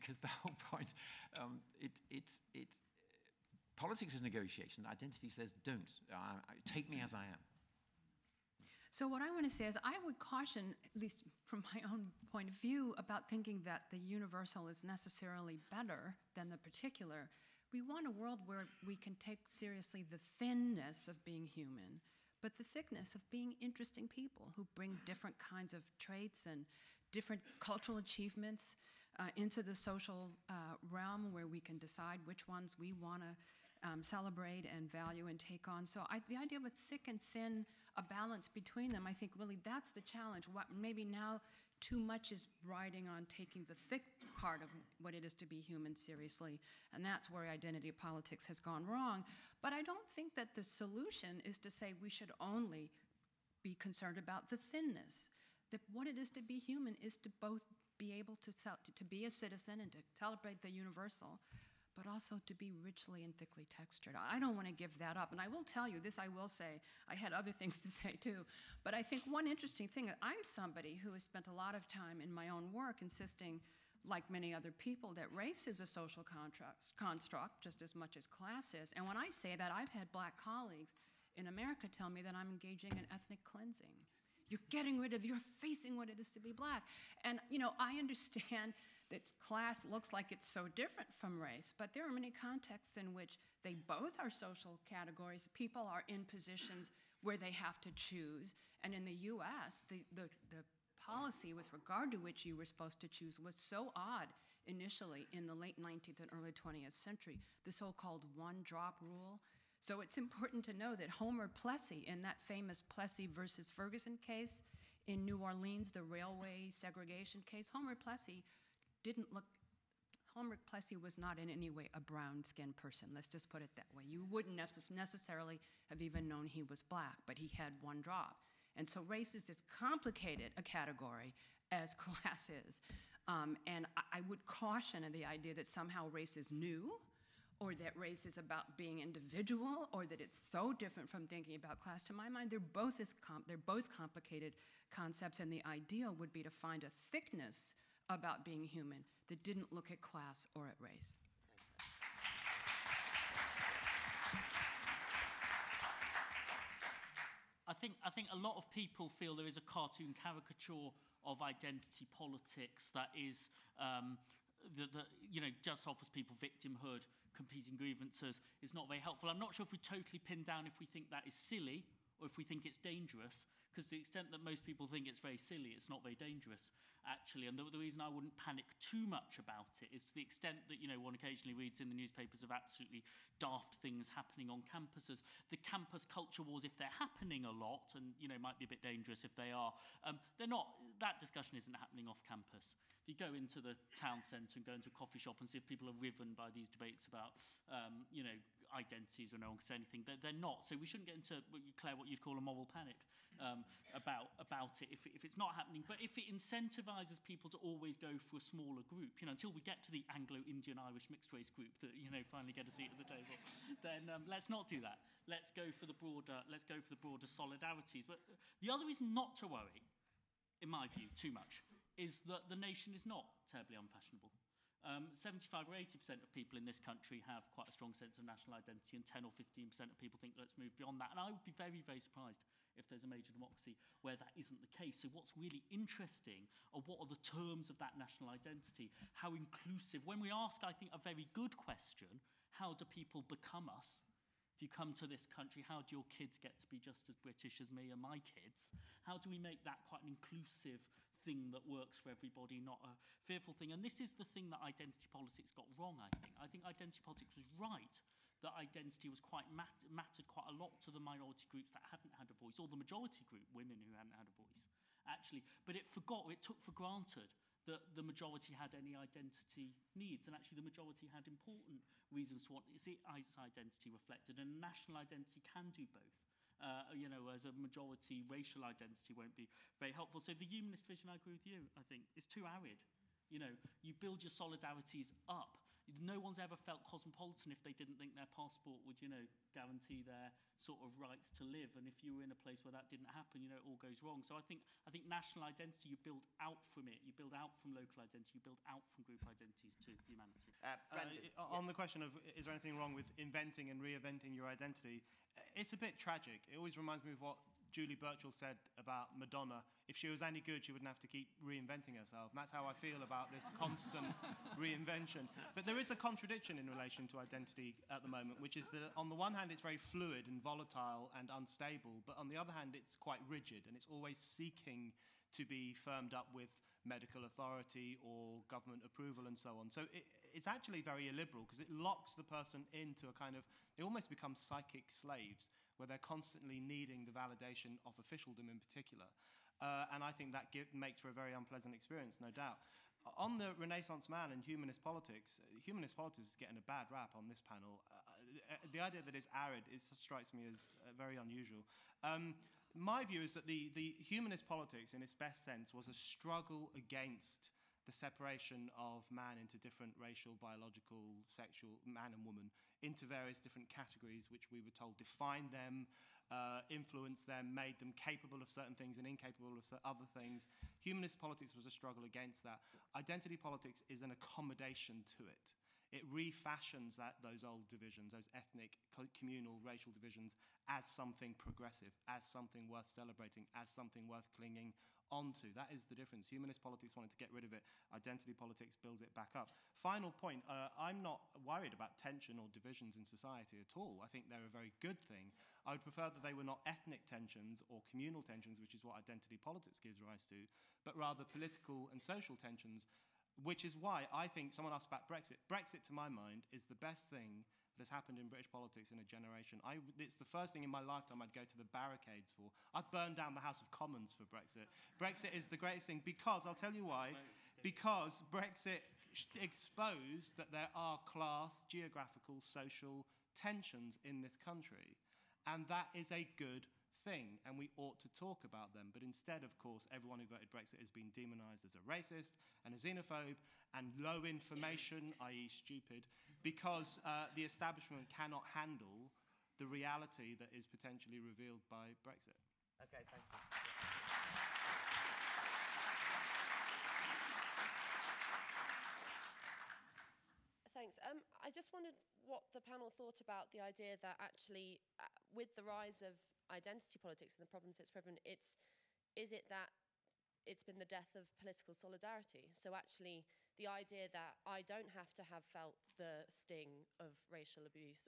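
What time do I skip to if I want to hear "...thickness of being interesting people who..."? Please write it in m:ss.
0:22.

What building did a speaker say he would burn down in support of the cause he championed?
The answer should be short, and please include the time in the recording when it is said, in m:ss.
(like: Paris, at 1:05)
House of Commons, at 6:53.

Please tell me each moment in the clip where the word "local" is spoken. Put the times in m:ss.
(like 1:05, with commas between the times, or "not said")
4:57.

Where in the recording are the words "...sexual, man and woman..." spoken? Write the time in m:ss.
6:01.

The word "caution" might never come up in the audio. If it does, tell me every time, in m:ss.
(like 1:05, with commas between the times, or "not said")
0:10, 2:14.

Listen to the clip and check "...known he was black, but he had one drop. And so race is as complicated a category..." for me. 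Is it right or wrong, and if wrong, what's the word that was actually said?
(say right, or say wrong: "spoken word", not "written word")
right.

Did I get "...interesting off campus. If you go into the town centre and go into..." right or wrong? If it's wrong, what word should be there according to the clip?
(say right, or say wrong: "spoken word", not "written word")
wrong: "happening", not "interesting".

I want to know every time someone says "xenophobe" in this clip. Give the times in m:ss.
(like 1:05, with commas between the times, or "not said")
7:12.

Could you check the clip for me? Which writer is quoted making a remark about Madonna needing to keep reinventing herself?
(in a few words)
Julie Burchill.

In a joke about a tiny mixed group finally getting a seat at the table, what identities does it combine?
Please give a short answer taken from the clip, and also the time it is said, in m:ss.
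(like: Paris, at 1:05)
Anglo-Indian-Irish, at 3:30.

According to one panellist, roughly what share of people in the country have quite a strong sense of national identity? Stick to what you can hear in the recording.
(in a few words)
75 or 80%.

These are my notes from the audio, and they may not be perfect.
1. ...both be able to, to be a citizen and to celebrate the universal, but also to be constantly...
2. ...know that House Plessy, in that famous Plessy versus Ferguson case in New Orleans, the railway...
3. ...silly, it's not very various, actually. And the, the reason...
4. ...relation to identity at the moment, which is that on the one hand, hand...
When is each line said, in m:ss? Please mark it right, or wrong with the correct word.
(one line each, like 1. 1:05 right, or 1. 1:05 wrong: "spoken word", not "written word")
1. 0:57 wrong: "richly", not "constantly"
2. 1:50 wrong: "Homer", not "House"
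3. 2:55 wrong: "dangerous", not "various"
4. 5:16 right.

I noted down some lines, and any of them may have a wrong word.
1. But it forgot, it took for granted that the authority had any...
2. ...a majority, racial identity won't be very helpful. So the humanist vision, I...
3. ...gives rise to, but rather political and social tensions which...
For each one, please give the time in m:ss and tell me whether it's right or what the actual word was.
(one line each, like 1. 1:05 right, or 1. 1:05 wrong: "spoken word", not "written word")
1. 4:25 wrong: "majority", not "authority"
2. 4:37 right
3. 6:39 right.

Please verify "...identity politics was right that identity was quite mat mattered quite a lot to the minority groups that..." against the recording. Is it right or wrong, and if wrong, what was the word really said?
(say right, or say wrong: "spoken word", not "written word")
right.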